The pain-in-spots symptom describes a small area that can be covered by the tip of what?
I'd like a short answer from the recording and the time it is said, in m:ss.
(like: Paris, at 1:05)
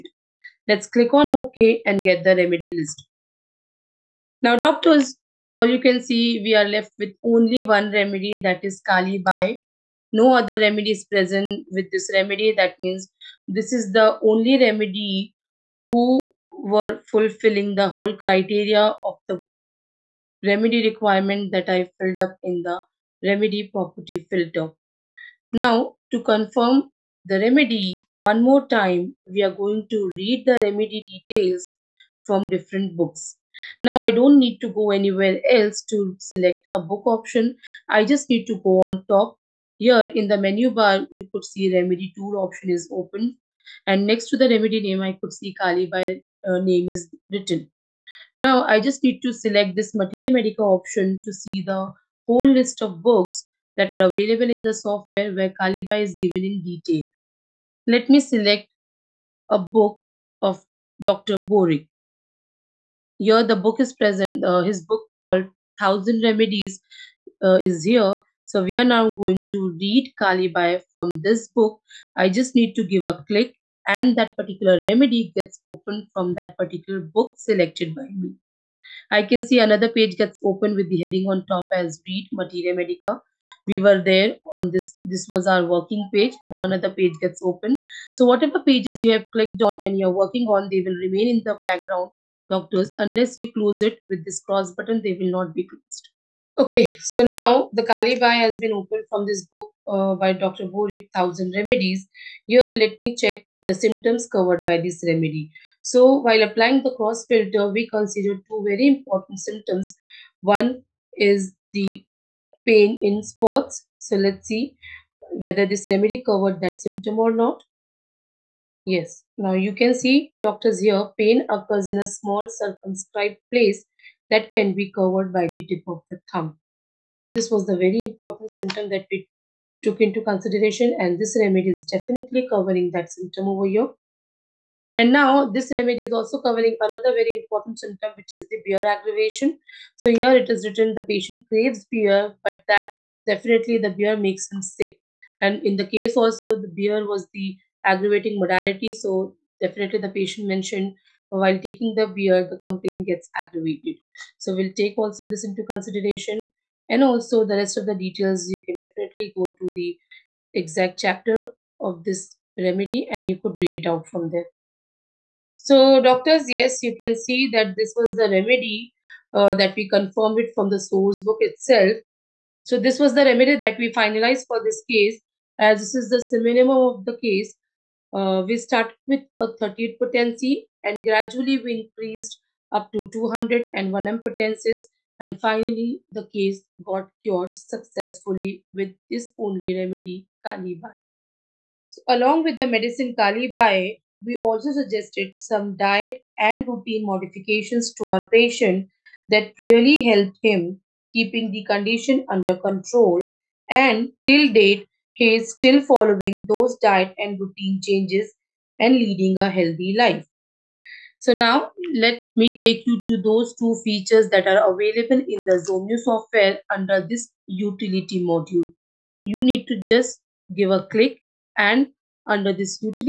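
The thumb, at 2:06.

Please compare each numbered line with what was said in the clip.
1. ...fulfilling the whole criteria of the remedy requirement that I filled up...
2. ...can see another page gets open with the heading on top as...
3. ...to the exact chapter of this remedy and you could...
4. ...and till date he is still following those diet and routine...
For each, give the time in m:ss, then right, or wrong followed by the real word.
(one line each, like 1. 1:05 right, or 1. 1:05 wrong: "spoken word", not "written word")
1. 0:17 right
2. 1:19 right
3. 2:39 right
4. 3:23 right.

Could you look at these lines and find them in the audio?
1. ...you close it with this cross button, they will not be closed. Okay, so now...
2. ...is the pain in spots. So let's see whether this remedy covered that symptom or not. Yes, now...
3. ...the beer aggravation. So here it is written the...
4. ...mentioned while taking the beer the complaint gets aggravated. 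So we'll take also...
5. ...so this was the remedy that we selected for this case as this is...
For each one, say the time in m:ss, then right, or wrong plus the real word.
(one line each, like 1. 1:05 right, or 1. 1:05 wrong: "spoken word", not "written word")
1. 1:33 right
2. 1:51 right
3. 2:18 right
4. 2:30 right
5. 2:52 wrong: "finalized", not "selected".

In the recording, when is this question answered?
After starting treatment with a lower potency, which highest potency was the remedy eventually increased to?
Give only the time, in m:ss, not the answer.
3:03.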